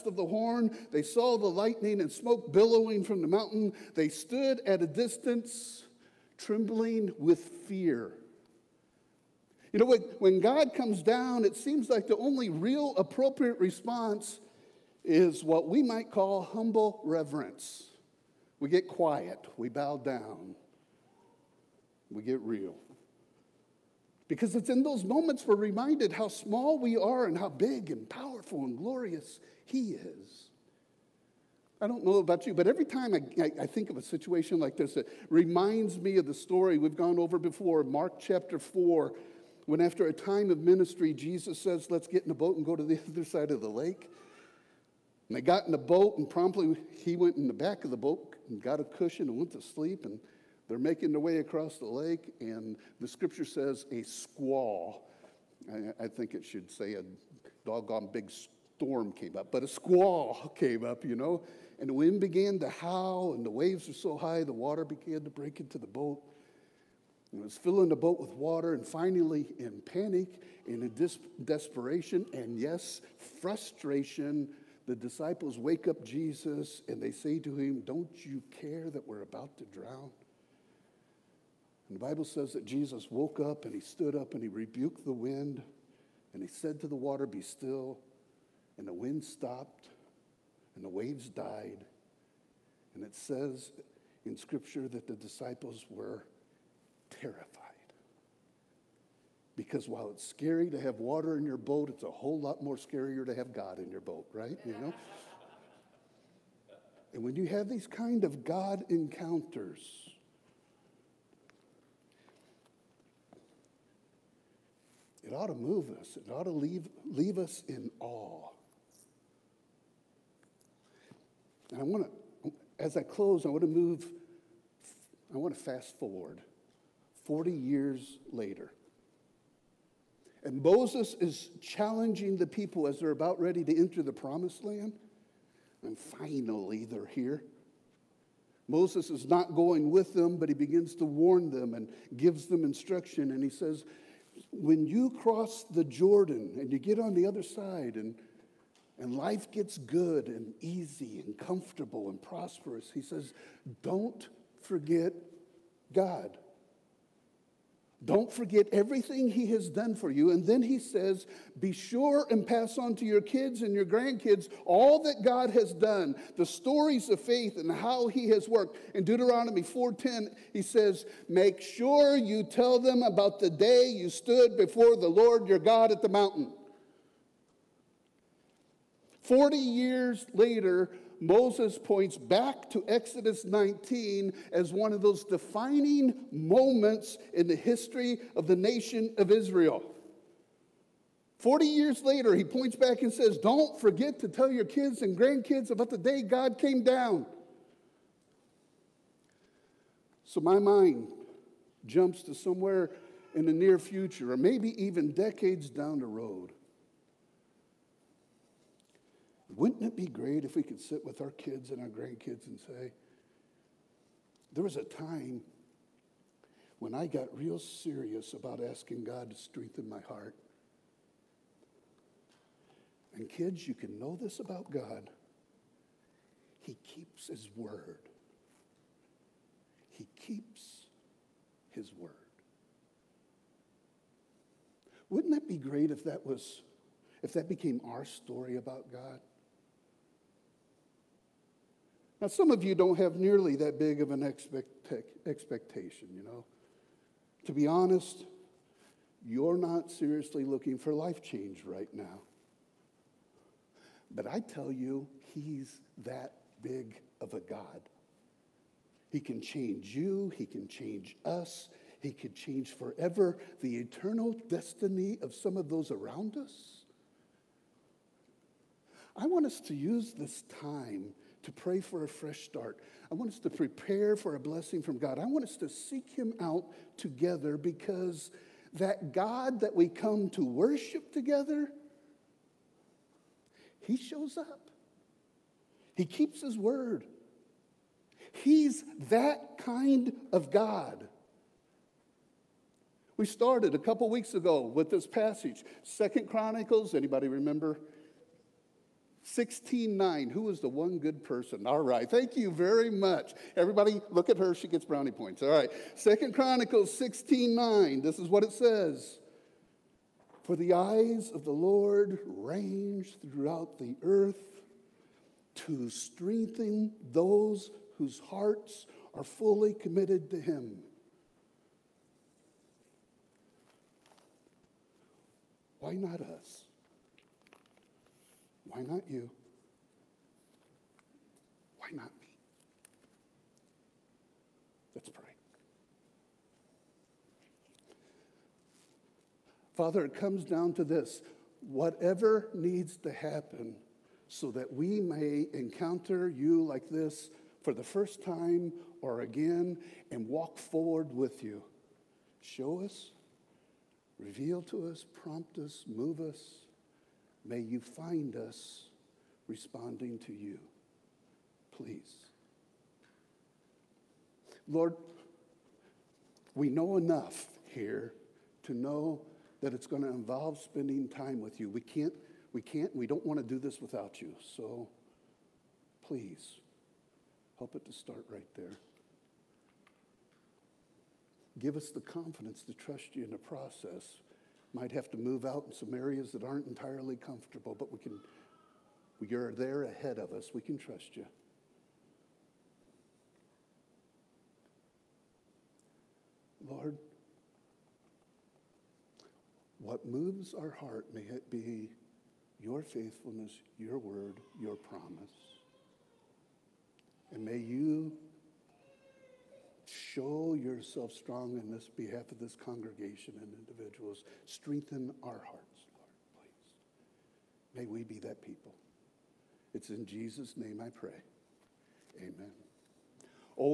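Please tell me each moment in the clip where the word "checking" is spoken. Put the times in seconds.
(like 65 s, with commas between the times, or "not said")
not said.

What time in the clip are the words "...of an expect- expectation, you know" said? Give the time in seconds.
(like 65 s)
244 s.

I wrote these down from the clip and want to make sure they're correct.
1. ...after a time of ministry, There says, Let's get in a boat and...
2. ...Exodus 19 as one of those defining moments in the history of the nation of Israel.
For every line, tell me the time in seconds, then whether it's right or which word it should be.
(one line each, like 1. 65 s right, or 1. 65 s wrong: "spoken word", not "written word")
1. 39 s wrong: "Jesus", not "There"
2. 182 s right.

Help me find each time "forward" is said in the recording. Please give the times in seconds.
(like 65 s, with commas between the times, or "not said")
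125 s, 350 s.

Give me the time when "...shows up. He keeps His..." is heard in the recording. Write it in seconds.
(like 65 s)
283 s.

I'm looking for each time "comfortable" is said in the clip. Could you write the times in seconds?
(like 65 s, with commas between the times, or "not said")
151 s, 387 s.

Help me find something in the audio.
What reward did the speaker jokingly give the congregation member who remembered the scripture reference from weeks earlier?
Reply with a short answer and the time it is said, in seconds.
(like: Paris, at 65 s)
Brownie points, at 304 s.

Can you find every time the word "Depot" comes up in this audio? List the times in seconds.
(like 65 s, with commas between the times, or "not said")
not said.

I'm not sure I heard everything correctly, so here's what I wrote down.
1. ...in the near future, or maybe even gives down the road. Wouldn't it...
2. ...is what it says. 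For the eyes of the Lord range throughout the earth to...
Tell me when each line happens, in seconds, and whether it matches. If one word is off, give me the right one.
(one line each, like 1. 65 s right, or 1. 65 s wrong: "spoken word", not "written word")
1. 203 s wrong: "decades", not "gives"
2. 308 s right.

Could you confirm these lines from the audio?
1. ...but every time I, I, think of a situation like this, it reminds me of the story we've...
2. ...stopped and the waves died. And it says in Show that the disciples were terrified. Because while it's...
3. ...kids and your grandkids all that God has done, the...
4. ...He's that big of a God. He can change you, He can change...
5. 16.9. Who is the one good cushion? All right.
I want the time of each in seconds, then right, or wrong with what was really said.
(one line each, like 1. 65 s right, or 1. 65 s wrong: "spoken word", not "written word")
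1. 32 s right
2. 89 s wrong: "Scripture", not "Show"
3. 163 s right
4. 255 s right
5. 299 s wrong: "person", not "cushion".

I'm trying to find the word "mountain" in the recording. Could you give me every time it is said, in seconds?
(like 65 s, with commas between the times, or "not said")
3 s, 176 s.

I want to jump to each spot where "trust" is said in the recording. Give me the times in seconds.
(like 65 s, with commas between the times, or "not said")
382 s, 390 s.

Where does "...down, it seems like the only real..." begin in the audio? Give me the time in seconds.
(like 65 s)
11 s.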